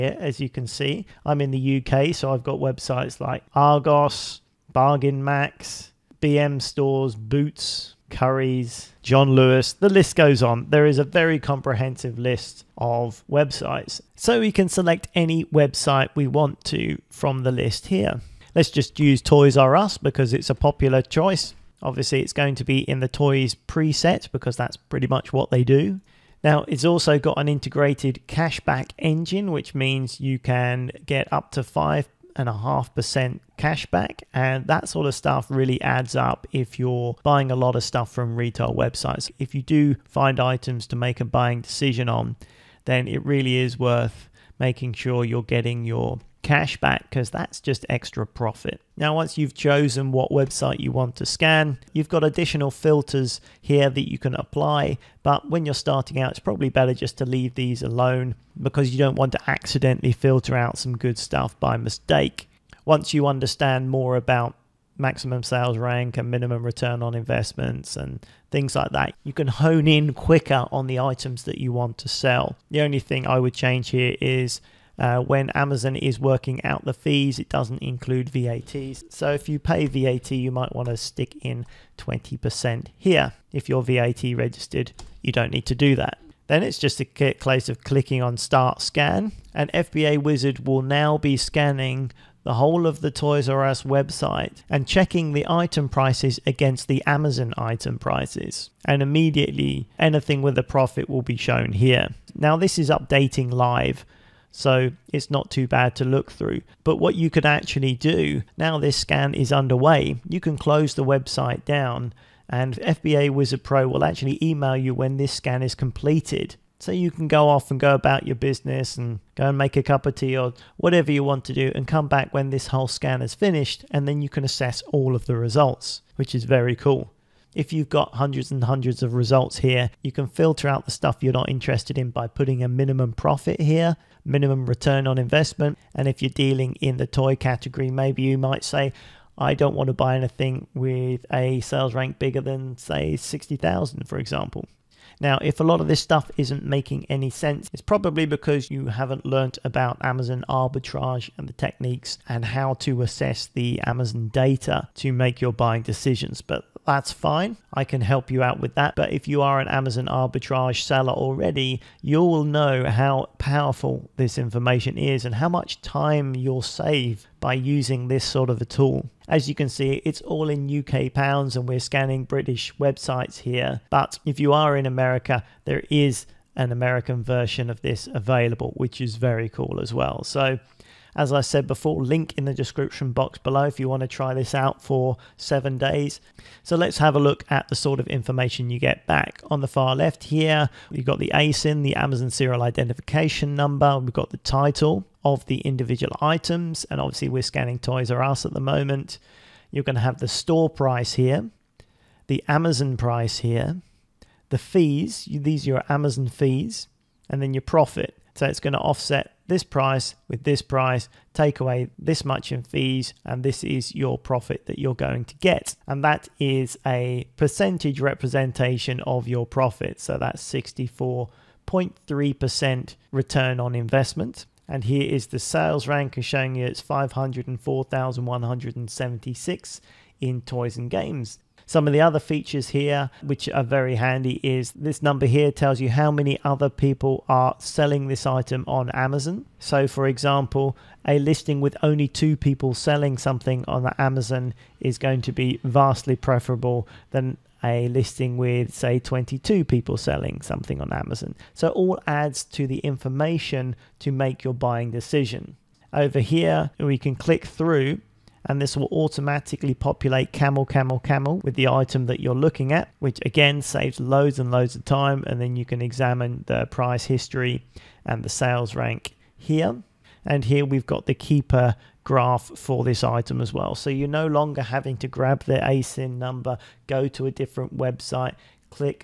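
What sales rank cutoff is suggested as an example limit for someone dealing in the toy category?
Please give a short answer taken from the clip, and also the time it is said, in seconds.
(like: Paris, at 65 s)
60,000, at 143 s.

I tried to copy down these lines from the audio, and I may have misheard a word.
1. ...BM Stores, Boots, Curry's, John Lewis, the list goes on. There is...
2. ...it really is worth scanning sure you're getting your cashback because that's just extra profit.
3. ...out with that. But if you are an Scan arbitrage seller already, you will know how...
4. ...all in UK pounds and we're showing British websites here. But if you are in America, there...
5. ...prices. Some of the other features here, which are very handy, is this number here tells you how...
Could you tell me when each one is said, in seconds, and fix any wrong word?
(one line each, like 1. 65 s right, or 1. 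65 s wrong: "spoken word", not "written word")
1. 6 s right
2. 43 s wrong: "making", not "scanning"
3. 158 s wrong: "Amazon", not "Scan"
4. 170 s wrong: "scanning", not "showing"
5. 230 s wrong: "games", not "prices".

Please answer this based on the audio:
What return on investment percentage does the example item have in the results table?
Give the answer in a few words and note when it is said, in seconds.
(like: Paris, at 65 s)
64.3%, at 220 s.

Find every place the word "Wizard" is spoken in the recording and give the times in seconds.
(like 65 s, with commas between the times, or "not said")
90 s, 113 s.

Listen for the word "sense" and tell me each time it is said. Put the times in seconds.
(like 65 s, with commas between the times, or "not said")
147 s.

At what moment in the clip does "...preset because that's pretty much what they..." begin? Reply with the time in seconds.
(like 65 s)
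23 s.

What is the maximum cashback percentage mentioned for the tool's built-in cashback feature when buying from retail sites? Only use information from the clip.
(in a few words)
5.5%.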